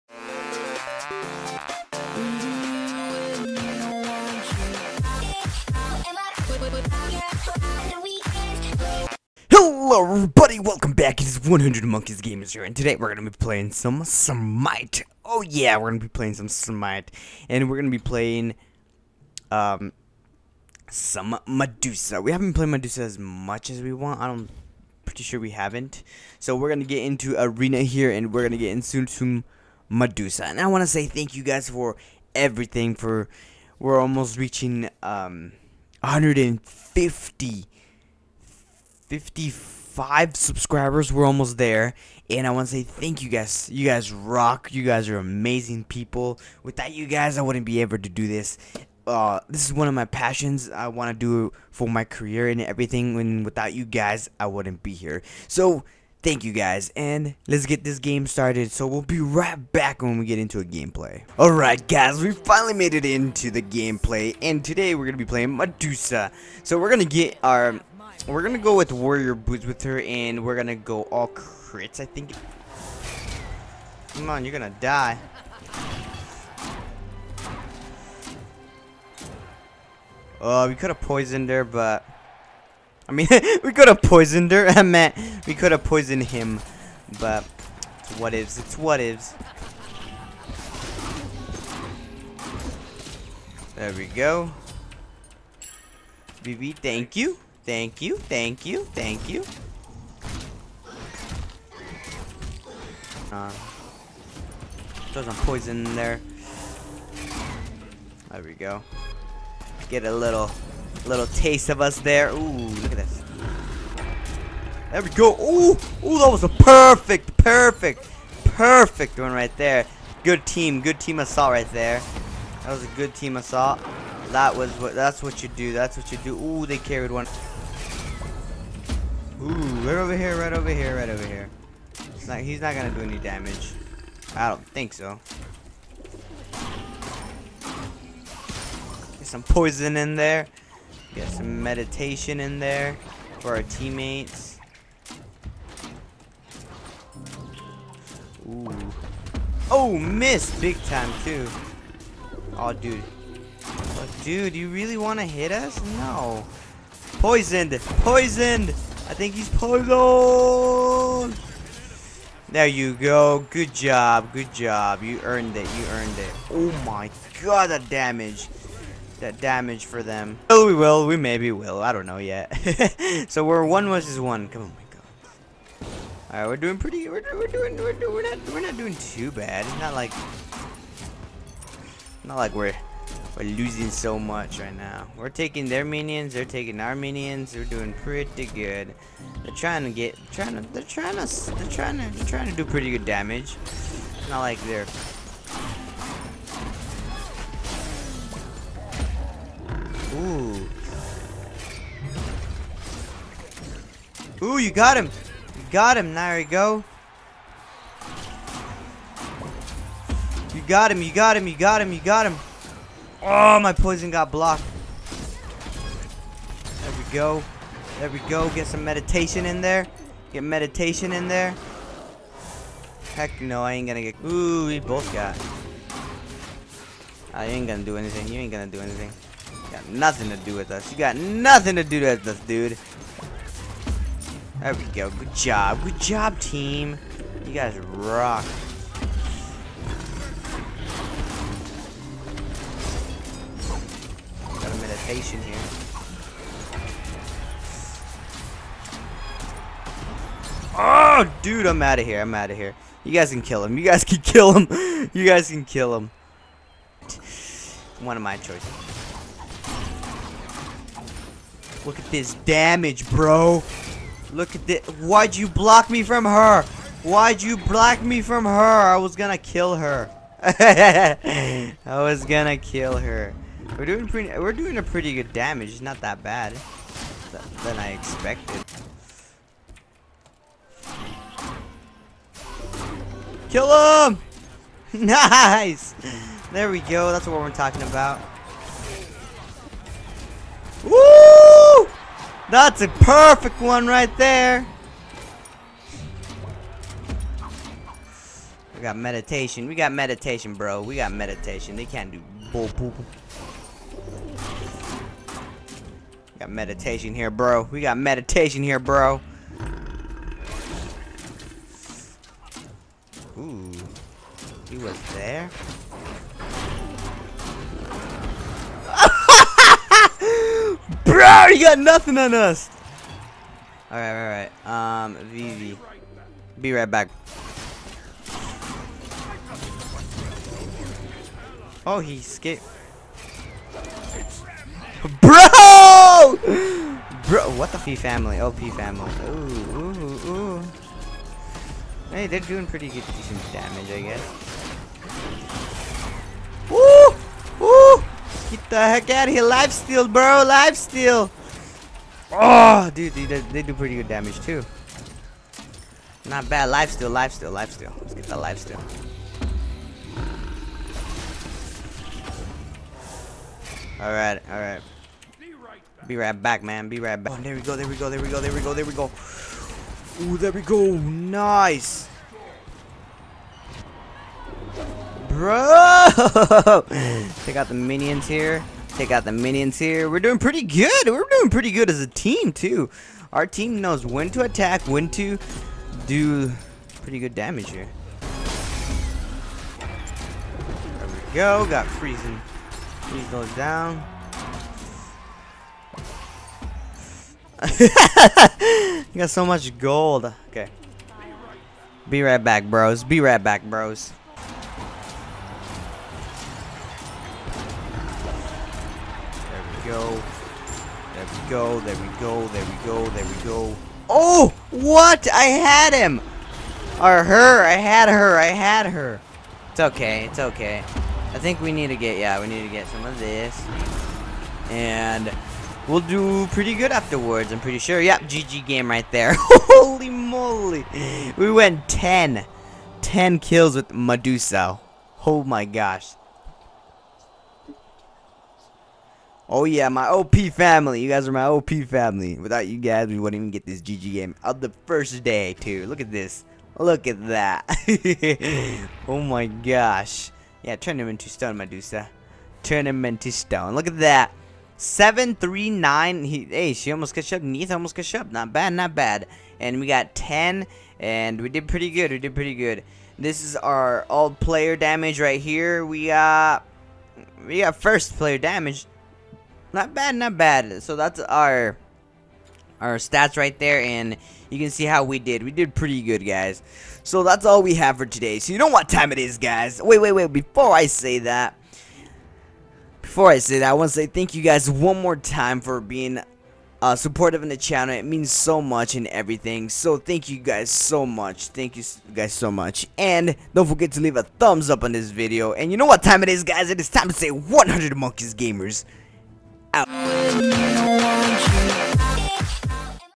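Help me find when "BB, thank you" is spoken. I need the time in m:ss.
1:36.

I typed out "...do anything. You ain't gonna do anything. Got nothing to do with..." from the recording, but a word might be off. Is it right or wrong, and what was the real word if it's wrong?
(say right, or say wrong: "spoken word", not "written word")
right.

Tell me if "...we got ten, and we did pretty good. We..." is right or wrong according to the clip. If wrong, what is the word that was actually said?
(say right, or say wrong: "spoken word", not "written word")
right.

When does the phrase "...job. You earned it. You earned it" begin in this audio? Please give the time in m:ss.
2:44.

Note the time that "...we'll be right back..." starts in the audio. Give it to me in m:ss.
0:58.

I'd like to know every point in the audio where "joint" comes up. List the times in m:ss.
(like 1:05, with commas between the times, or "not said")
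not said.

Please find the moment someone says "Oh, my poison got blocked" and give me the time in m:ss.
3:33.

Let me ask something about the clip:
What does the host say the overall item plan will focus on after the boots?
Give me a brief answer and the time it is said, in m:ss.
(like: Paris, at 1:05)
Crits, at 1:11.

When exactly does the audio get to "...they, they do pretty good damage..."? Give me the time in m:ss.
5:53.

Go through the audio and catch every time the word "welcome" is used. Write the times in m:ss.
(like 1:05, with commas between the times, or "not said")
0:10.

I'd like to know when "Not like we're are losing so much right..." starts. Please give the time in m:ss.
3:02.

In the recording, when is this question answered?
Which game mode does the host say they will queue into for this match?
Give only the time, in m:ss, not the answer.
0:27.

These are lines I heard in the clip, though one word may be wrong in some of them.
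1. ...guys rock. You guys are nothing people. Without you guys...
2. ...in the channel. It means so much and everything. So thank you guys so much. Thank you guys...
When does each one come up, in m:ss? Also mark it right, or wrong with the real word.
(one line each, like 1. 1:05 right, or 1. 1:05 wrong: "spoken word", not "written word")
1. 0:43 wrong: "amazing", not "nothing"
2. 8:07 right.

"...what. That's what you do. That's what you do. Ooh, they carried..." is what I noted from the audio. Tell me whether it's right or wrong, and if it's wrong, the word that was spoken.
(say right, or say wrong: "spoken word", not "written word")
right.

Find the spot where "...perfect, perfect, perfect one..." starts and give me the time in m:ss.
1:56.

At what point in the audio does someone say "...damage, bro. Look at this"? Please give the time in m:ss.
4:22.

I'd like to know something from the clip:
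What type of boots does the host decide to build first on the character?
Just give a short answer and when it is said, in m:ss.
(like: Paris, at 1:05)
Warrior boots, at 1:08.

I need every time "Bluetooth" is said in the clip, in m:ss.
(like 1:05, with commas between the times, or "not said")
not said.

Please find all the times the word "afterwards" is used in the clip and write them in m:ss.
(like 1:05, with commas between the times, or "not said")
7:06.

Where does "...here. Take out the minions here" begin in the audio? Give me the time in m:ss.
6:18.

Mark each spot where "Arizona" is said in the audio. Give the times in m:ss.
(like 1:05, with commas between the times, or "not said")
not said.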